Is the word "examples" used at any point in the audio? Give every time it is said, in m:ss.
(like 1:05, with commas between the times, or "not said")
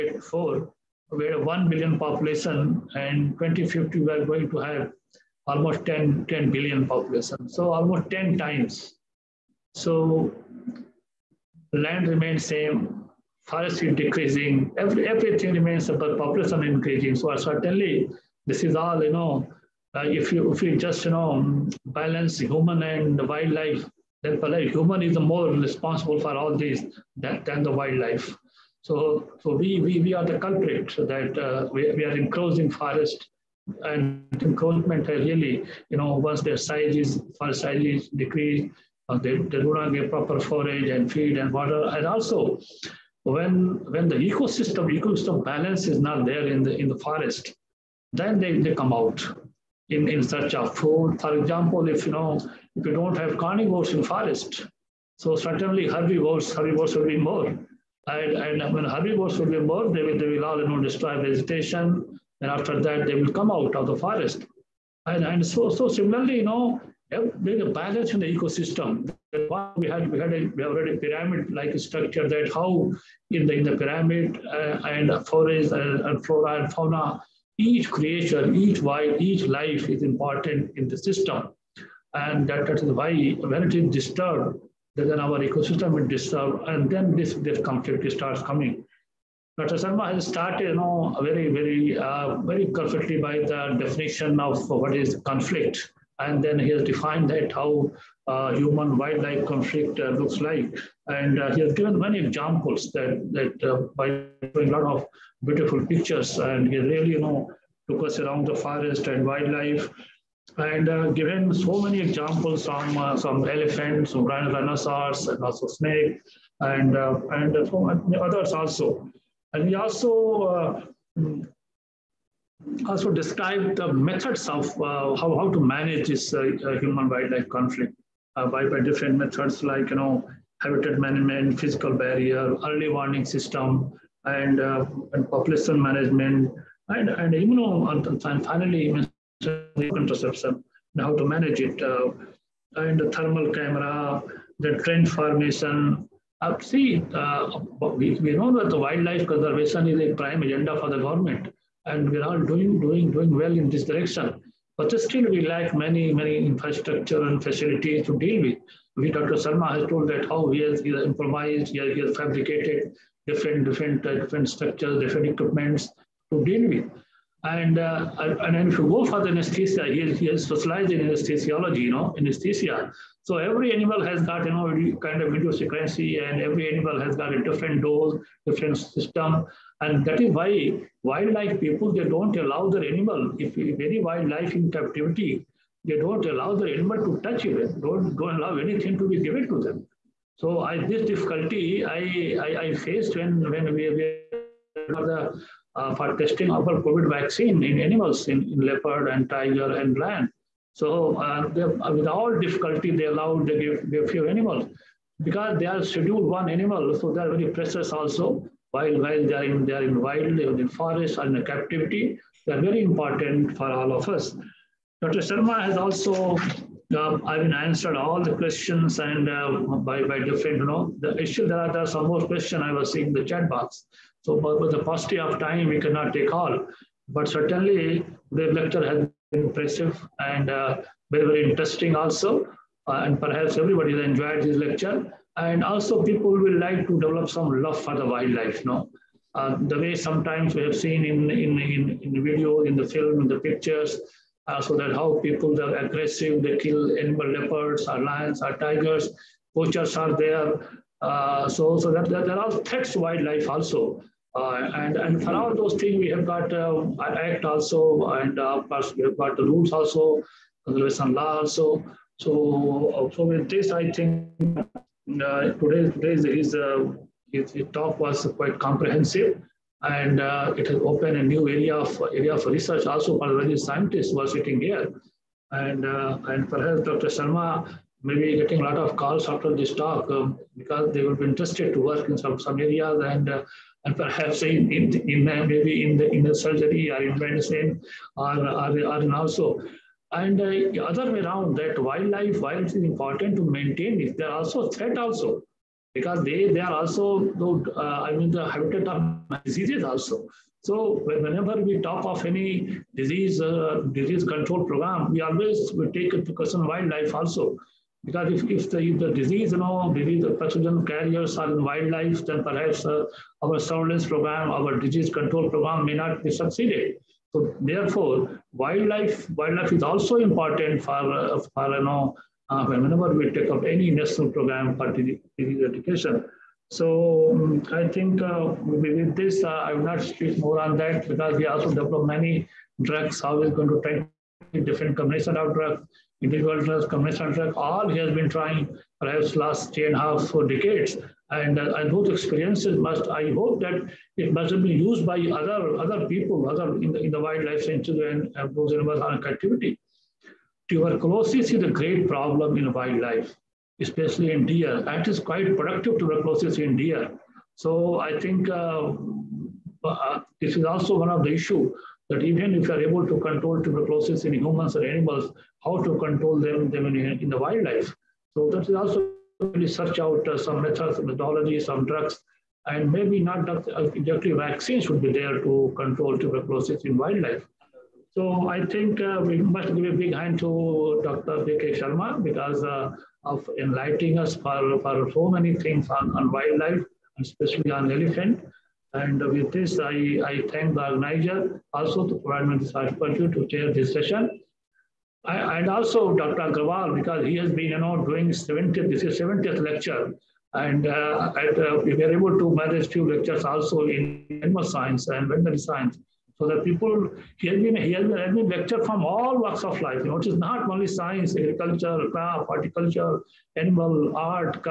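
0:51, 1:42, 1:52.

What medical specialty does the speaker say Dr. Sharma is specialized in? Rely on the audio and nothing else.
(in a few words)
Anesthesiology.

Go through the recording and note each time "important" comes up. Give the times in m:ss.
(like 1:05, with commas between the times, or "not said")
1:20, 3:32, 4:52, 5:20.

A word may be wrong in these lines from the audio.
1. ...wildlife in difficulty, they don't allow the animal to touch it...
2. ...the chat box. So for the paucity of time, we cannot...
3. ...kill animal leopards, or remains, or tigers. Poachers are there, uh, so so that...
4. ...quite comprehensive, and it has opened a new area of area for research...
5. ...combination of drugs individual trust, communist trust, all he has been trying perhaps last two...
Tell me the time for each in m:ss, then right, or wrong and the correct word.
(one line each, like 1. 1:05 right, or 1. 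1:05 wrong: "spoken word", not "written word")
1. 3:04 wrong: "captivity", not "difficulty"
2. 3:43 right
3. 4:06 wrong: "lions", not "remains"
4. 4:28 right
5. 5:34 wrong: "three", not "two".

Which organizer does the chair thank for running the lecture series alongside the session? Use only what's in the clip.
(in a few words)
Dr. Agarwal.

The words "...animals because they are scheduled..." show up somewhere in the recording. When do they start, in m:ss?
3:24.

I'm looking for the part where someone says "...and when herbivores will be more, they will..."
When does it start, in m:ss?
0:58.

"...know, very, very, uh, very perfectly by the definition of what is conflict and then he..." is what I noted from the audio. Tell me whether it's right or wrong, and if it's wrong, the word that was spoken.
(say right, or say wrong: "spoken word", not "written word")
right.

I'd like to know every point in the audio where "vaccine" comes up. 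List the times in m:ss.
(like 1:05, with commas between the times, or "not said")
3:17, 6:14.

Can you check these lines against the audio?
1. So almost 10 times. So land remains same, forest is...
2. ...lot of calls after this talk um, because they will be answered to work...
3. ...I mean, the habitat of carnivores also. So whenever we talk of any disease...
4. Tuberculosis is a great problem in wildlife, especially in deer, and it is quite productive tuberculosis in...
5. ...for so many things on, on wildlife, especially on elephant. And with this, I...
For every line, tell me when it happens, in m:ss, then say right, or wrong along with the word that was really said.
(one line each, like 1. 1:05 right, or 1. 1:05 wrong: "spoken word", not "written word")
1. 0:07 right
2. 4:38 wrong: "interested", not "answered"
3. 4:57 wrong: "diseases", not "carnivores"
4. 5:50 right
5. 6:24 right.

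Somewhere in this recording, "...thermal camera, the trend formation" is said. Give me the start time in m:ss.
2:23.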